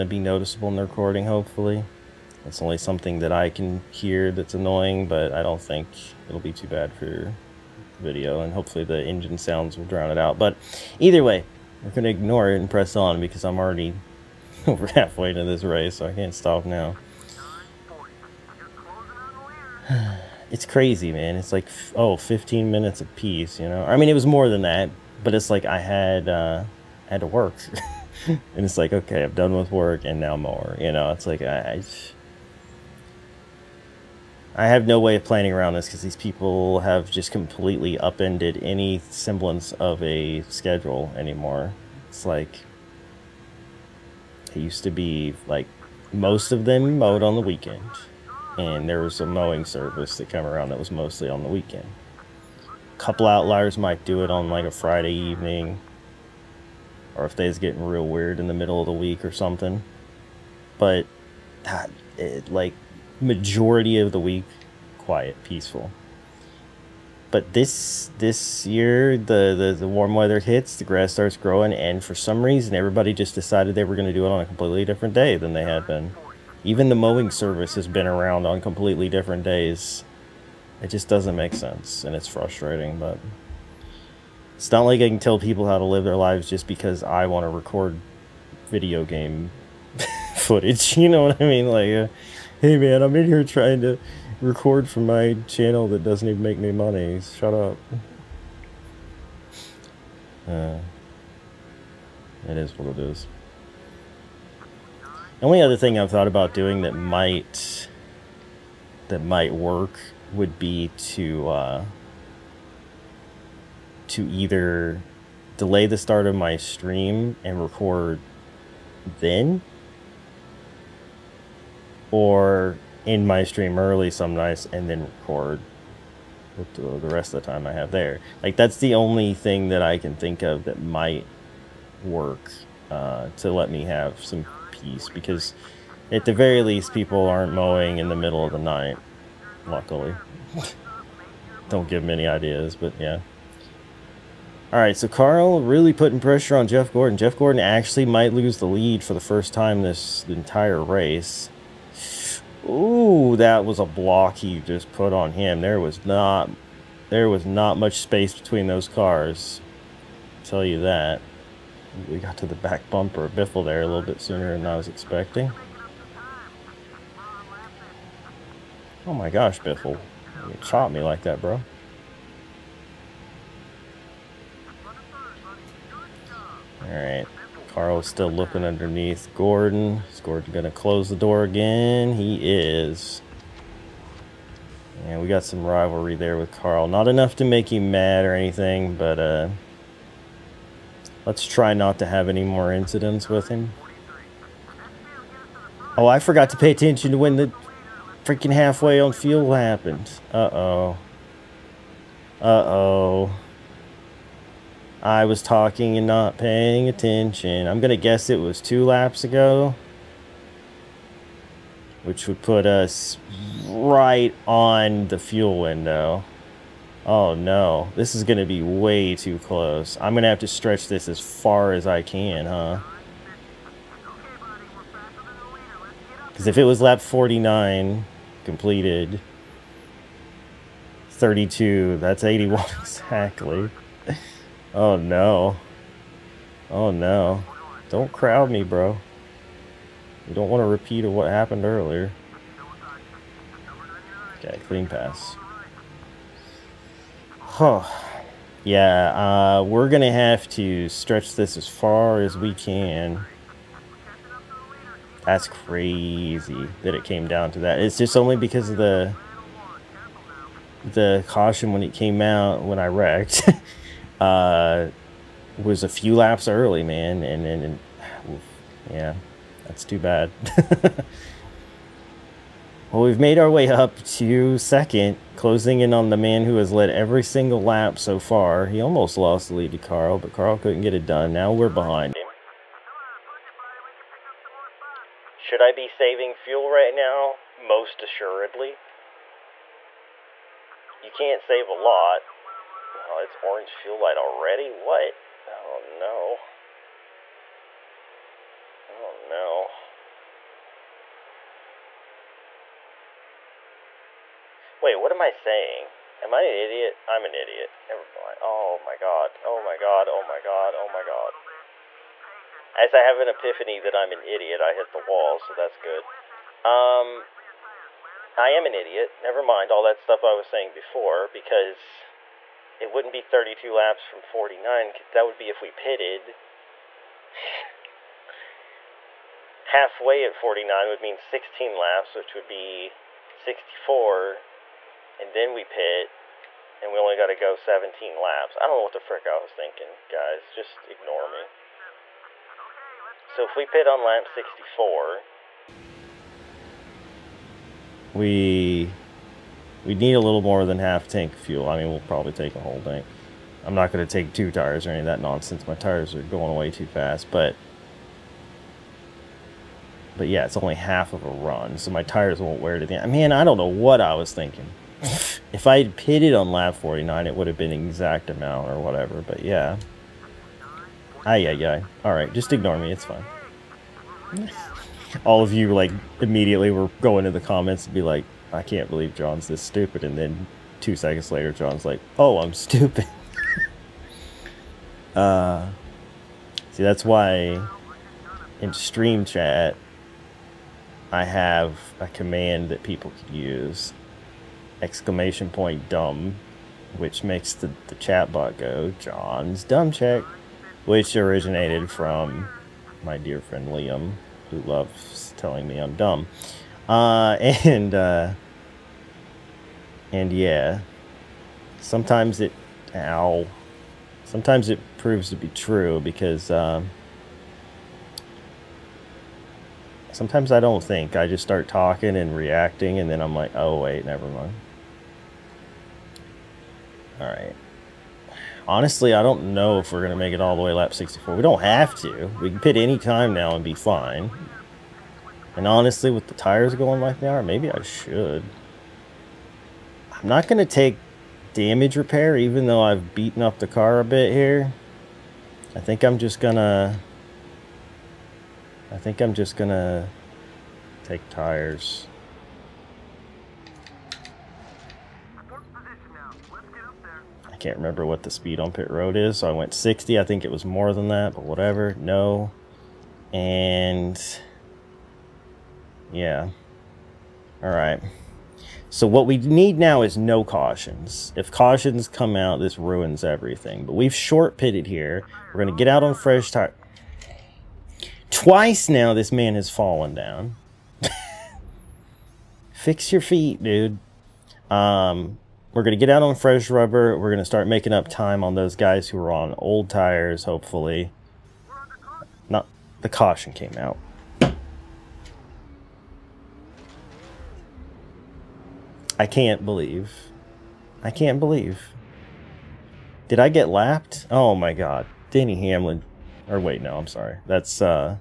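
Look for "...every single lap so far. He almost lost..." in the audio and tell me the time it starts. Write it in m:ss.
4:36.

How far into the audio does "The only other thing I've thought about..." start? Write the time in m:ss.
1:45.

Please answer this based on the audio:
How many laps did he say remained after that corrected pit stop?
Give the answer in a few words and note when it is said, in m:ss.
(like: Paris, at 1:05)
17, at 5:37.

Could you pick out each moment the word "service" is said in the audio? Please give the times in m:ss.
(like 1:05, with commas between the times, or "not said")
0:49, 1:17.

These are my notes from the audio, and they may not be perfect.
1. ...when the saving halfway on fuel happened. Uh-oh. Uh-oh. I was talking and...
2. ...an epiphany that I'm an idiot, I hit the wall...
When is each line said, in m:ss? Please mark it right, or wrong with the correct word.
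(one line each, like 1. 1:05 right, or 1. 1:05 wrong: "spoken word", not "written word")
1. 3:17 wrong: "freaking", not "saving"
2. 5:13 right.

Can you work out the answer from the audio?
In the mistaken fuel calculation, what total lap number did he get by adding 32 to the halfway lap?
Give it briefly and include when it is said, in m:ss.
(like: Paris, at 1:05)
81, at 3:52.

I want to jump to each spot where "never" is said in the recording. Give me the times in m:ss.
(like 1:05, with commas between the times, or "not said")
5:07, 5:19, 7:04.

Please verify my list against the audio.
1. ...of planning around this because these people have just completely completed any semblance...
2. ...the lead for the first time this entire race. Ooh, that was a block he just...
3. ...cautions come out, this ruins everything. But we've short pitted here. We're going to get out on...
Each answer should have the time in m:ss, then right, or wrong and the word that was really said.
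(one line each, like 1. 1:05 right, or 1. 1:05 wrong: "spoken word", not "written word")
1. 0:35 wrong: "upended", not "completed"
2. 2:28 right
3. 7:51 right.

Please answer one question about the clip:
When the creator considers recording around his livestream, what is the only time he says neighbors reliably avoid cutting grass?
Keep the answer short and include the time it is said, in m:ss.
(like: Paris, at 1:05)
the middle of the night, at 2:18.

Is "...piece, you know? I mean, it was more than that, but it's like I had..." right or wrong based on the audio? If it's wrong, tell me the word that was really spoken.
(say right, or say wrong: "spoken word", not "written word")
right.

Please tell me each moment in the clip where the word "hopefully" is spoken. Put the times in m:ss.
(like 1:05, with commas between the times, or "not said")
0:01, 0:08, 8:10.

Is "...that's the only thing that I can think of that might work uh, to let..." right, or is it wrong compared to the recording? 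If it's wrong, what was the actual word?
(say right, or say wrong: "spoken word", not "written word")
right.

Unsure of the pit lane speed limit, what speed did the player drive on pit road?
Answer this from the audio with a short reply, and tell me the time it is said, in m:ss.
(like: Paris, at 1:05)
60, at 7:39.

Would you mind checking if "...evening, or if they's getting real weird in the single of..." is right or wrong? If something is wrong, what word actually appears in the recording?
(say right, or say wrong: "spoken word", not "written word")
wrong: "middle", not "single".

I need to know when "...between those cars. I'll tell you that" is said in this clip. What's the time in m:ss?
2:38.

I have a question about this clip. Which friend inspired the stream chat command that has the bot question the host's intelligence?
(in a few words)
Liam.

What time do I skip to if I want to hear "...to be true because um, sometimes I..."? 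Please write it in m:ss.
6:55.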